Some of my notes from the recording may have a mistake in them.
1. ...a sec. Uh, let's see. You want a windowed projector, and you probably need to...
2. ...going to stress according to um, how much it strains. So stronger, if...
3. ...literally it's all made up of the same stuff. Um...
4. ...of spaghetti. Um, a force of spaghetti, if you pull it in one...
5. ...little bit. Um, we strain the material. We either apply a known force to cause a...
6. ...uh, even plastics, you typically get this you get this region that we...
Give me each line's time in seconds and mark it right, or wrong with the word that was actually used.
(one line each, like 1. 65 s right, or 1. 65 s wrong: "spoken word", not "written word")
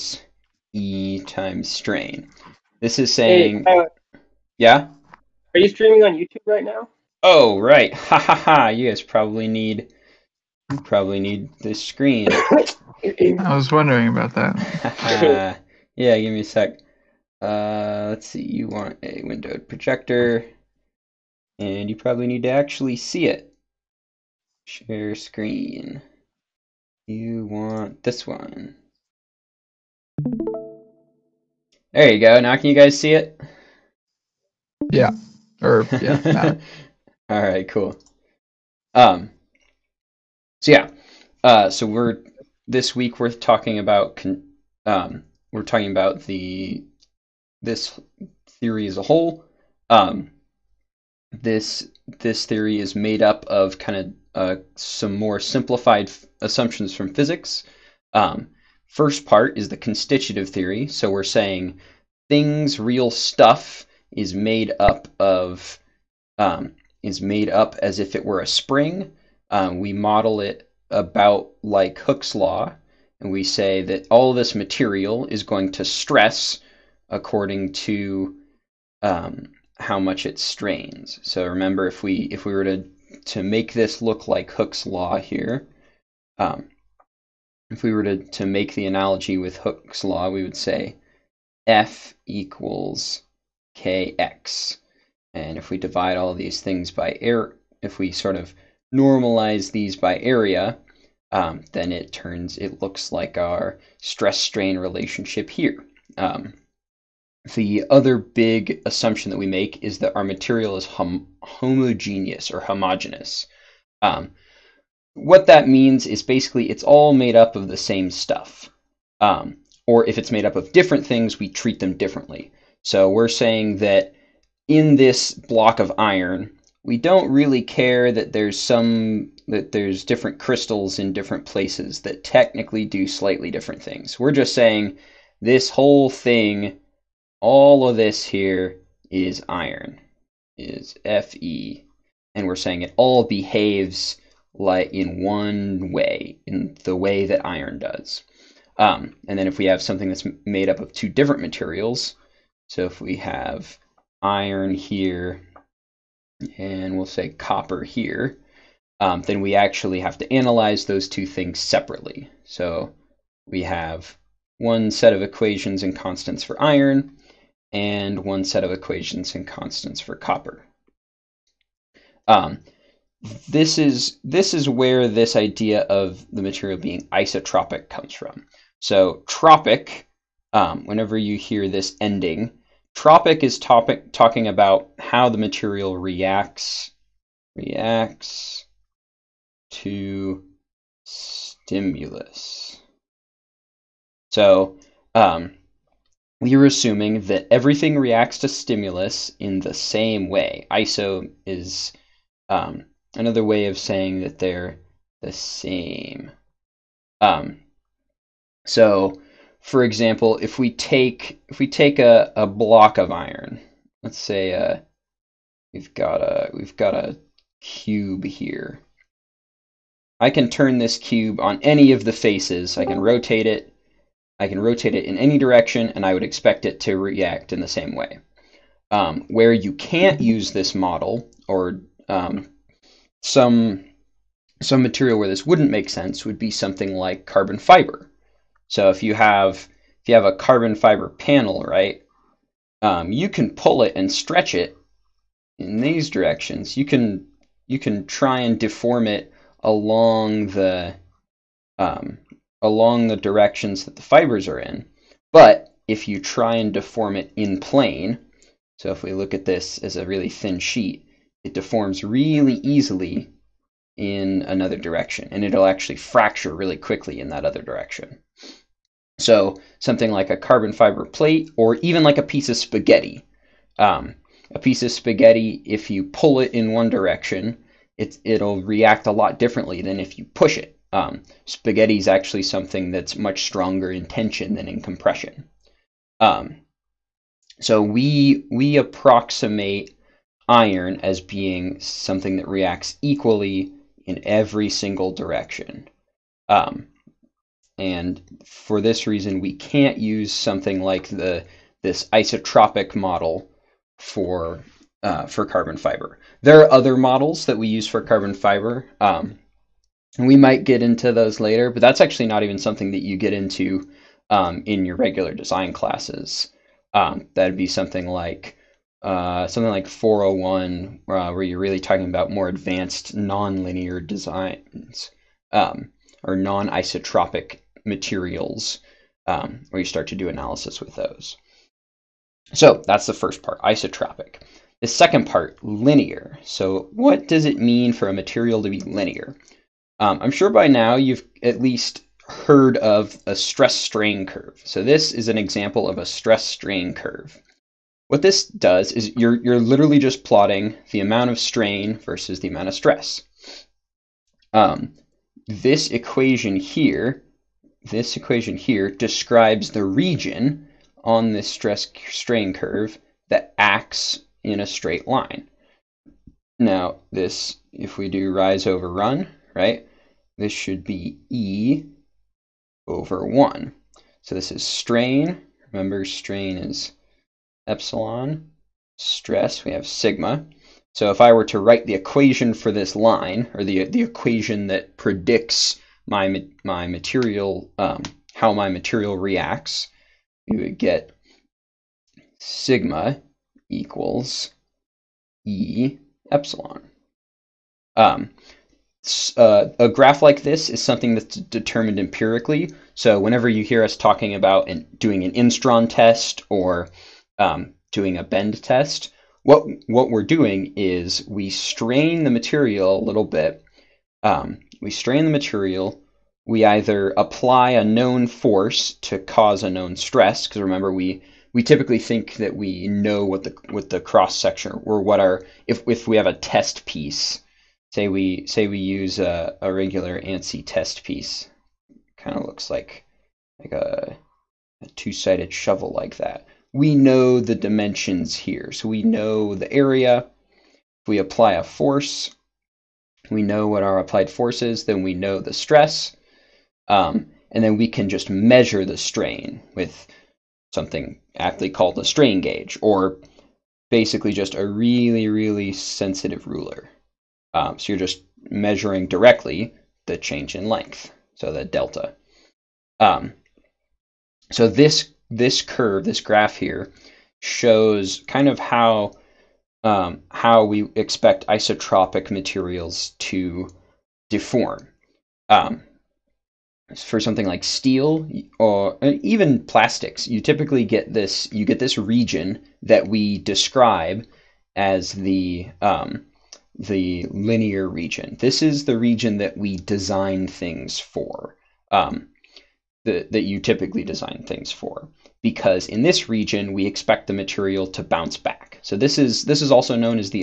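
1. 16 s right
2. 75 s wrong: "remember", not "stronger"
3. 116 s wrong: "basically", not "literally"
4. 272 s wrong: "piece", not "force"
5. 413 s right
6. 479 s right.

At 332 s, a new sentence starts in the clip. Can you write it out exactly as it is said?
So that's the first part, isotropic.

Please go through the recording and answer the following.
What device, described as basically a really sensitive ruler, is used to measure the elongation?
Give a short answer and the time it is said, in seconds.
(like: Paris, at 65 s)
strain gauge, at 452 s.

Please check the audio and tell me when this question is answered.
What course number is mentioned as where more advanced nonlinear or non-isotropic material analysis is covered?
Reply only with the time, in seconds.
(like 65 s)
319 s.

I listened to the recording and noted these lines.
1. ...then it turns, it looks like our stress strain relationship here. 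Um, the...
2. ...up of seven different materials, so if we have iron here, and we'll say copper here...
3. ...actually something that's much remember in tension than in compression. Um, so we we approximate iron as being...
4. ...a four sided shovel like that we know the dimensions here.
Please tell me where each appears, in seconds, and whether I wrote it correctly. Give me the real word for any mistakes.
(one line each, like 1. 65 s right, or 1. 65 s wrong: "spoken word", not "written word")
1. 101 s right
2. 150 s wrong: "two", not "seven"
3. 282 s wrong: "stronger", not "remember"
4. 434 s wrong: "two", not "four".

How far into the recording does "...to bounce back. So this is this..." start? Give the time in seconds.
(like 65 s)
497 s.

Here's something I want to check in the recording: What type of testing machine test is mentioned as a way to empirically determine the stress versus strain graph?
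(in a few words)
instron test.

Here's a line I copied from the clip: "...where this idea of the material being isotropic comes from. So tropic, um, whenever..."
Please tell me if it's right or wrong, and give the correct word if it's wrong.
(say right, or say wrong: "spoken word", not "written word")
right.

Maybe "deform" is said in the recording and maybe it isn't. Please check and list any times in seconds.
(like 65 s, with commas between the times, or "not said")
248 s, 256 s, 261 s, 474 s.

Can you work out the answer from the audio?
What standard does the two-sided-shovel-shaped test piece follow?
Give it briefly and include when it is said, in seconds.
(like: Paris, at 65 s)
ANSI, at 430 s.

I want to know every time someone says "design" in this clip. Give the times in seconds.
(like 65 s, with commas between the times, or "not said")
315 s, 324 s, 489 s, 494 s.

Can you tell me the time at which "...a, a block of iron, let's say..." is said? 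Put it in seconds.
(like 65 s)
211 s.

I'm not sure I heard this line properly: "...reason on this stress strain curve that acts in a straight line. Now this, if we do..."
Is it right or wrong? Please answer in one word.
wrong.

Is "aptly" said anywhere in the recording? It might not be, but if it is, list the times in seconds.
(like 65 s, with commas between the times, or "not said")
451 s.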